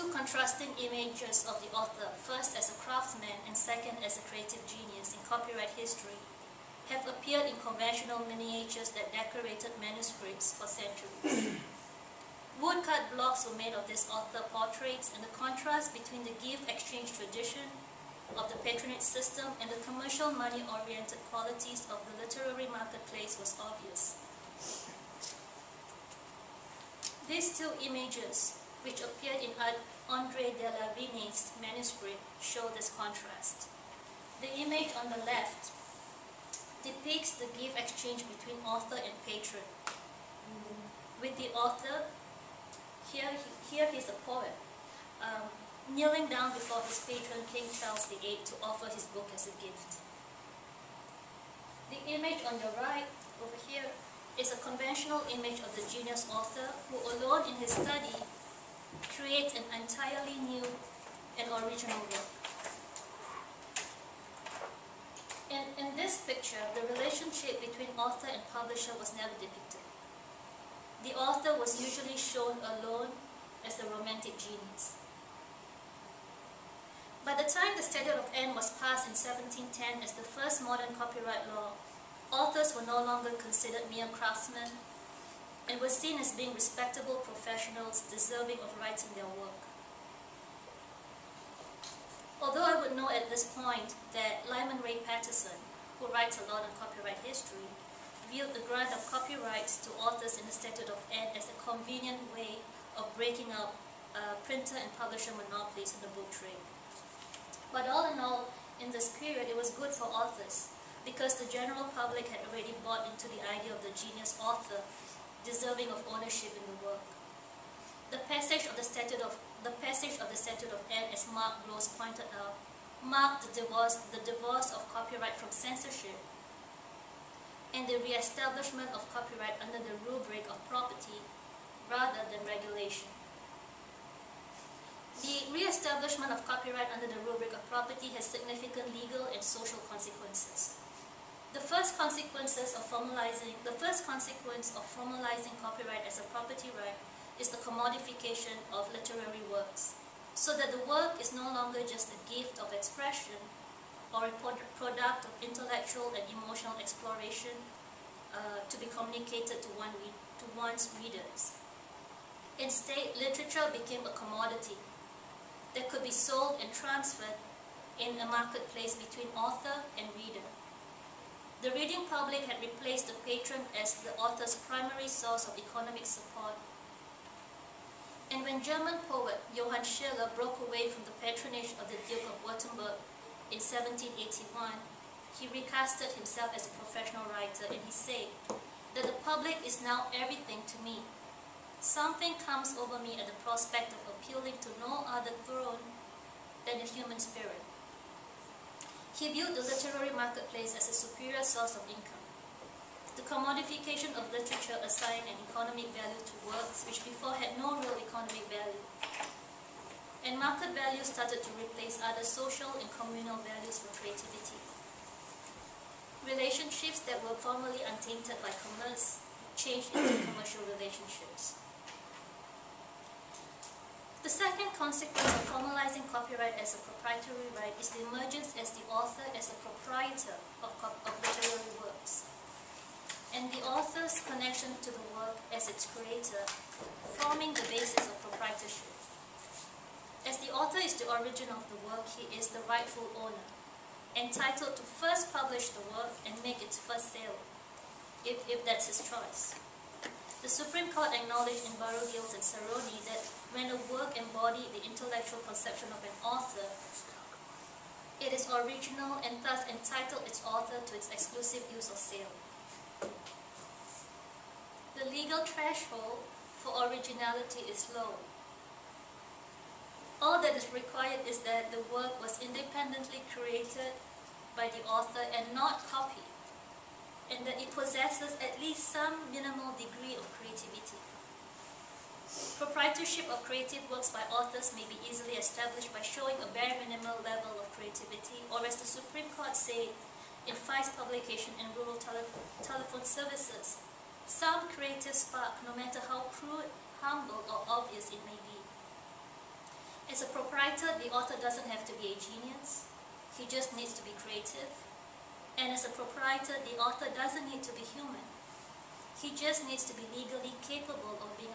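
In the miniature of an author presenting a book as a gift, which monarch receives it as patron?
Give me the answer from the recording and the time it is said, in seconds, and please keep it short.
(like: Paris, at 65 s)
King Charles VIII, at 47 s.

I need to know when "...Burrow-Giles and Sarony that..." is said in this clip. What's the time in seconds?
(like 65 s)
251 s.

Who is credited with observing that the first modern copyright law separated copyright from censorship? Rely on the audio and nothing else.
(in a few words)
Mark Gross.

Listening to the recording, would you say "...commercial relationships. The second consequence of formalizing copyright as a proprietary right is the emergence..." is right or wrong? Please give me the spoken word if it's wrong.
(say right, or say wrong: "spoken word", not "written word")
right.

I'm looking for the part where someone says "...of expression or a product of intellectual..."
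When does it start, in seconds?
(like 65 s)
152 s.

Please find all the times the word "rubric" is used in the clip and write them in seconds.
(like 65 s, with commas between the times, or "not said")
130 s, 137 s.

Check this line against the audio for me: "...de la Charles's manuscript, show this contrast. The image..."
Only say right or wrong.
wrong.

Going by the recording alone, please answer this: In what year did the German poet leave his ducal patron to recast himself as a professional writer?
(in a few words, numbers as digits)
1781.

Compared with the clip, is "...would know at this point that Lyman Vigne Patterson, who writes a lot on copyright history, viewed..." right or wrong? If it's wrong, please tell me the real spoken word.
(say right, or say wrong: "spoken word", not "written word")
wrong: "Ray", not "Vigne".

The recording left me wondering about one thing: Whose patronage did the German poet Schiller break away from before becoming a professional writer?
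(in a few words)
the Duke of Württemberg.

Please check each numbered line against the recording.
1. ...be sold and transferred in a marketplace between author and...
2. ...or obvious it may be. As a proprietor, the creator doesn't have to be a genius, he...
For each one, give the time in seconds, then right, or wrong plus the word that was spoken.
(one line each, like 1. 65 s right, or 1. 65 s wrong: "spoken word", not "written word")
1. 166 s right
2. 297 s wrong: "author", not "creator".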